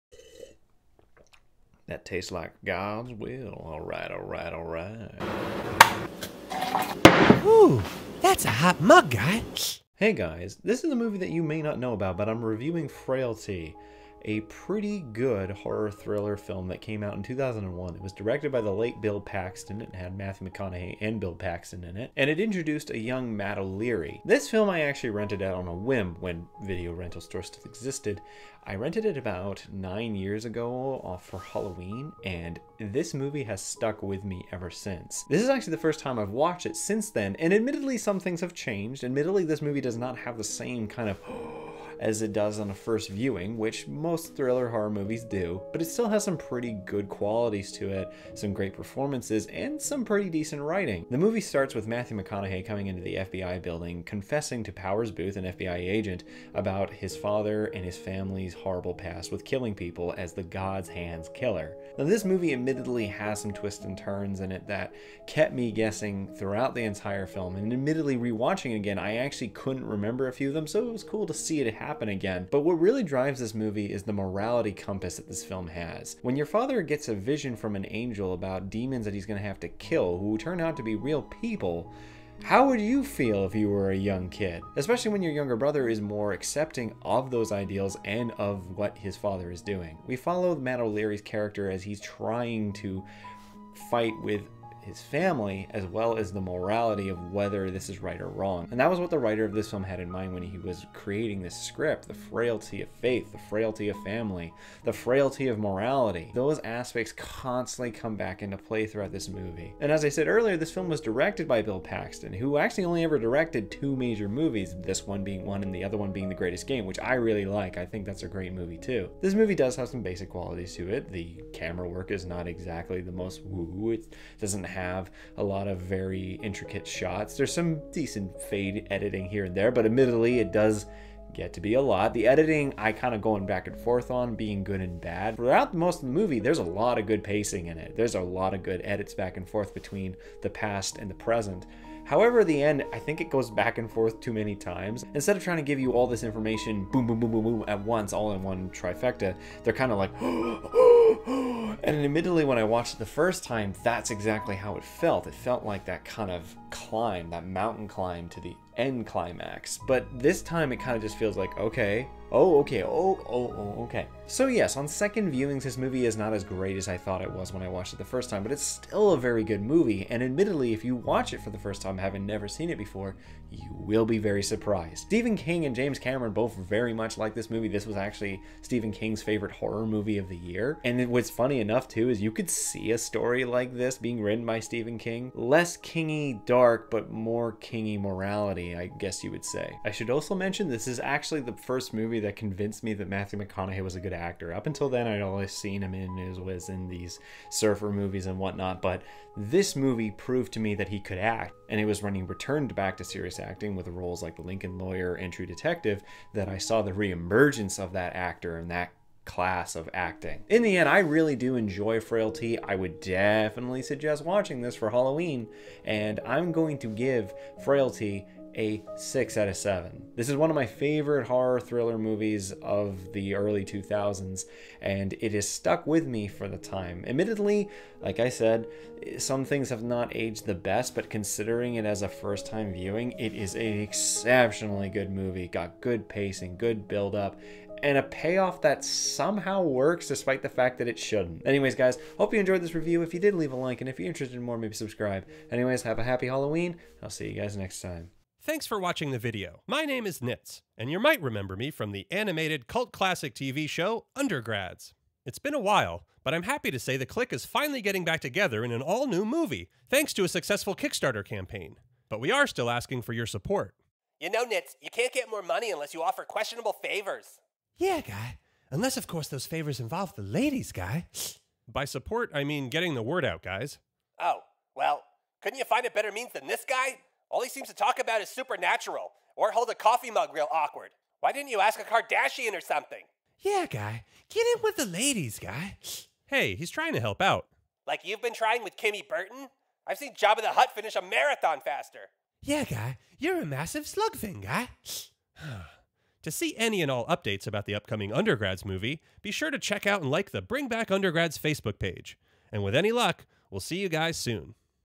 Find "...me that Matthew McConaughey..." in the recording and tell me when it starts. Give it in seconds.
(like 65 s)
192 s.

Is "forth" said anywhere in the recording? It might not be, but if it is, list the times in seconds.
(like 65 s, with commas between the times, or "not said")
133 s, 139 s, 143 s.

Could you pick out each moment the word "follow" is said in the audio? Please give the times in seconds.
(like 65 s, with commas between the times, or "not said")
90 s.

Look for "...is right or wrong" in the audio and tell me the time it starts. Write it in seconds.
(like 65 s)
97 s.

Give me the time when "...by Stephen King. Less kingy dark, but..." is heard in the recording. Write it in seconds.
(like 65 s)
184 s.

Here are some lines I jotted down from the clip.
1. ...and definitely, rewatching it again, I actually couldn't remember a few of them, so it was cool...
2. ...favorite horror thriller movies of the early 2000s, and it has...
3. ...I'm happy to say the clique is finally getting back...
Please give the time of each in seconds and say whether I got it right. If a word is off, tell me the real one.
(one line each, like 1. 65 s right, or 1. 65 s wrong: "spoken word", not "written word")
1. 67 s wrong: "admittedly", not "definitely"
2. 220 s right
3. 256 s right.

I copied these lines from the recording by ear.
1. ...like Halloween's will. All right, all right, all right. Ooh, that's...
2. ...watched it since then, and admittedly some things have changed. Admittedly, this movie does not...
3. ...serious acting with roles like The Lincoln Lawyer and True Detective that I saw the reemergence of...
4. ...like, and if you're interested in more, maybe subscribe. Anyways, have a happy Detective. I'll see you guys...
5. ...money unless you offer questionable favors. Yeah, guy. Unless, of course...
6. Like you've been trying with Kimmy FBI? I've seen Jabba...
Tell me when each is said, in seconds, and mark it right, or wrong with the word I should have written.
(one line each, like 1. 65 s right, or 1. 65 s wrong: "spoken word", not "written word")
1. 2 s wrong: "God", not "Halloween"
2. 36 s right
3. 203 s right
4. 243 s wrong: "Halloween", not "Detective"
5. 265 s right
6. 287 s wrong: "Burton", not "FBI".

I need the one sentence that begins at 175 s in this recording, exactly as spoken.
Stephen King and James Cameron both very much like this movie.